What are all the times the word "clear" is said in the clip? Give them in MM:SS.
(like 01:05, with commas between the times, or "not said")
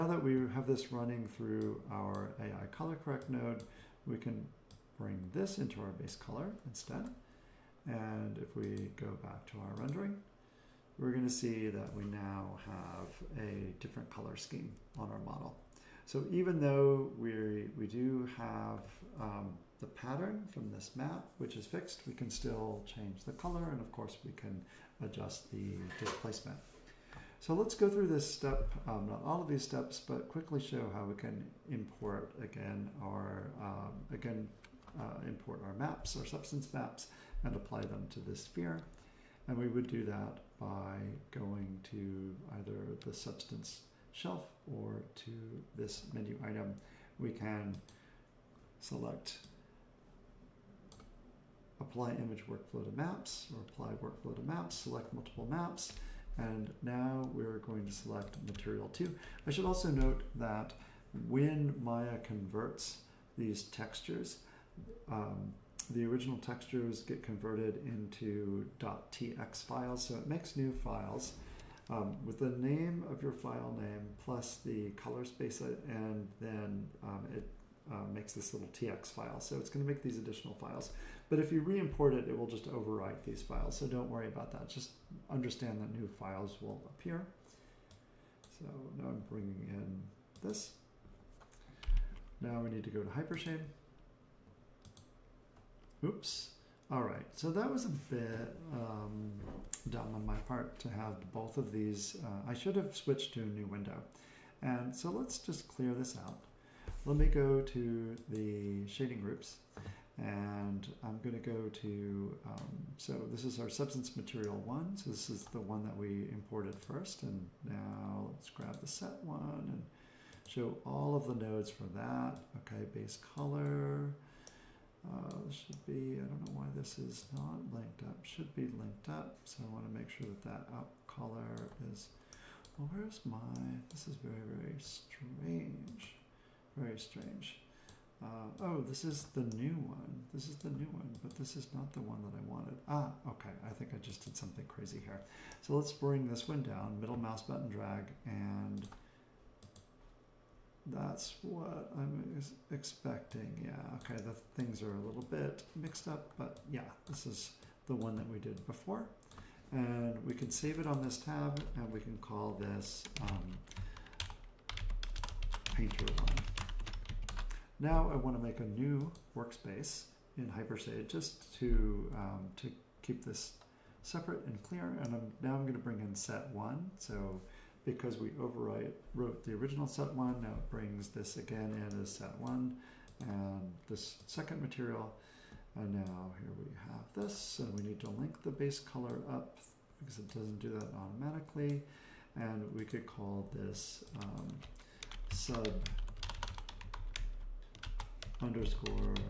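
01:45, 02:54.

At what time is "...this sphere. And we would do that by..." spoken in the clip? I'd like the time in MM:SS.
00:38.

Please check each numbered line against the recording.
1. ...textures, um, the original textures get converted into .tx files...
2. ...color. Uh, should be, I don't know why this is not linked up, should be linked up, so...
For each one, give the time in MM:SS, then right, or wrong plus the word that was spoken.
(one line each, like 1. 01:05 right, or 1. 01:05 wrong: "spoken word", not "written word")
1. 01:03 right
2. 02:03 right.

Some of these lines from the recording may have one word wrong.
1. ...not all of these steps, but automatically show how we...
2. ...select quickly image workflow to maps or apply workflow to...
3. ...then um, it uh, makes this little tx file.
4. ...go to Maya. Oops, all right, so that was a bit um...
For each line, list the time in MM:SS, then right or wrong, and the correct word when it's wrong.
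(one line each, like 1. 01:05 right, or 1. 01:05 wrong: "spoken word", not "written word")
1. 00:29 wrong: "quickly", not "automatically"
2. 00:48 wrong: "apply", not "quickly"
3. 01:16 right
4. 01:32 wrong: "Hypershade", not "Maya".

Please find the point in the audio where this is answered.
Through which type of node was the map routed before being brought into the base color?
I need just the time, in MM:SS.
00:02.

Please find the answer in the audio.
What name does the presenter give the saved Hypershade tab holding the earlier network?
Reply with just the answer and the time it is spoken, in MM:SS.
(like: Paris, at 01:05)
Painter 1, at 02:45.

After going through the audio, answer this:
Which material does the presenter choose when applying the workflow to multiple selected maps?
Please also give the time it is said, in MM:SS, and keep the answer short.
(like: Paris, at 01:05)
material two, at 00:58.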